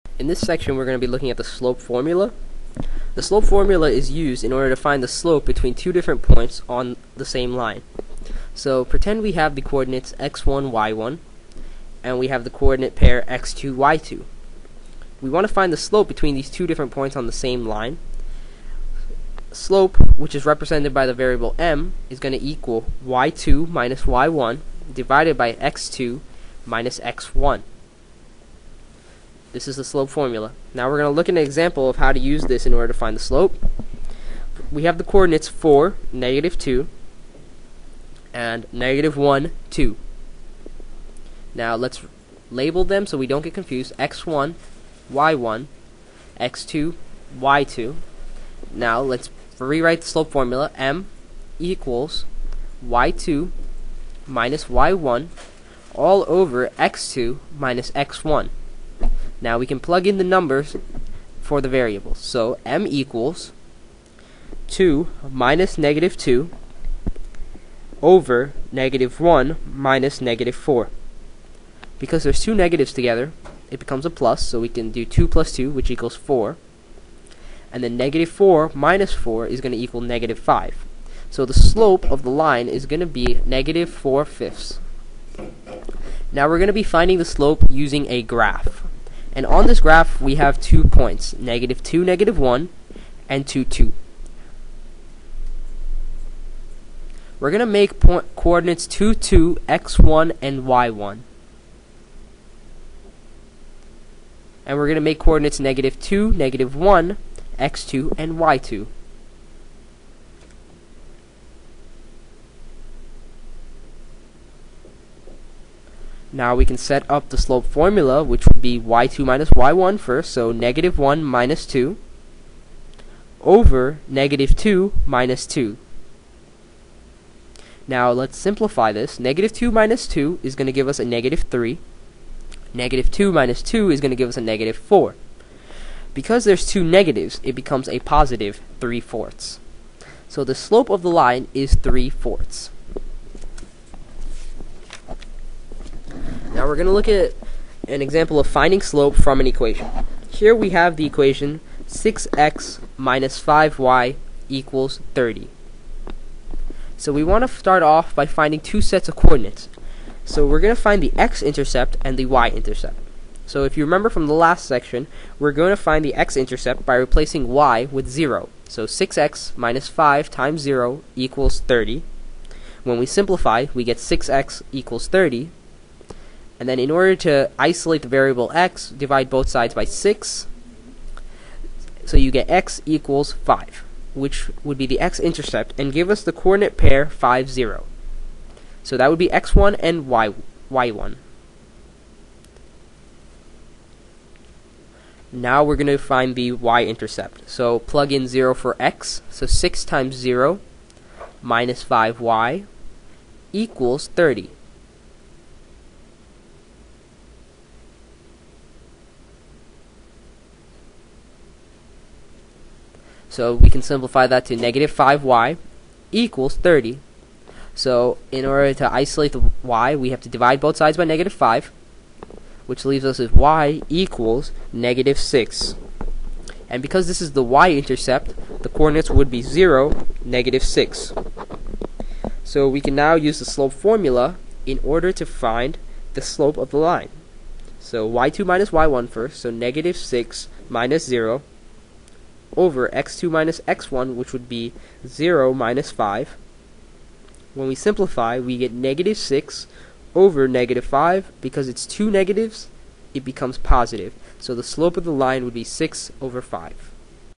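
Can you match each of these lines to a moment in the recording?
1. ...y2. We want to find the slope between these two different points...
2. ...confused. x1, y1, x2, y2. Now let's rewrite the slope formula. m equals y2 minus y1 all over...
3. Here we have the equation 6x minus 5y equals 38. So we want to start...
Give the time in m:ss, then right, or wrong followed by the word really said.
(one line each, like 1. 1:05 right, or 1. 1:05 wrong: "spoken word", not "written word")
1. 0:13 right
2. 0:43 right
3. 2:30 wrong: "30", not "38".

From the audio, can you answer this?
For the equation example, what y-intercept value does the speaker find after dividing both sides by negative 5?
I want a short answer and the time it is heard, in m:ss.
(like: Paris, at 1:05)
-6, at 3:43.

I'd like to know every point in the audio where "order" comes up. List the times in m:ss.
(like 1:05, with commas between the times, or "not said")
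0:04, 0:32, 2:56, 3:38, 3:54.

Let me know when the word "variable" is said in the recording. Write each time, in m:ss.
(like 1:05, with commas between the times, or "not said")
0:21, 1:01, 2:58.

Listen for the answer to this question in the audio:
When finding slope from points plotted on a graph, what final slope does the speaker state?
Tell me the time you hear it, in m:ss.
2:17.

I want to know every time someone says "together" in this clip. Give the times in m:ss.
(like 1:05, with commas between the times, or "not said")
1:12.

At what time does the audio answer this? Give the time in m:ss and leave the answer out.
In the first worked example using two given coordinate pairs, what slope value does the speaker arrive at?
1:23.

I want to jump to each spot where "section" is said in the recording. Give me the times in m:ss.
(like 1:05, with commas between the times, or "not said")
0:00, 2:44.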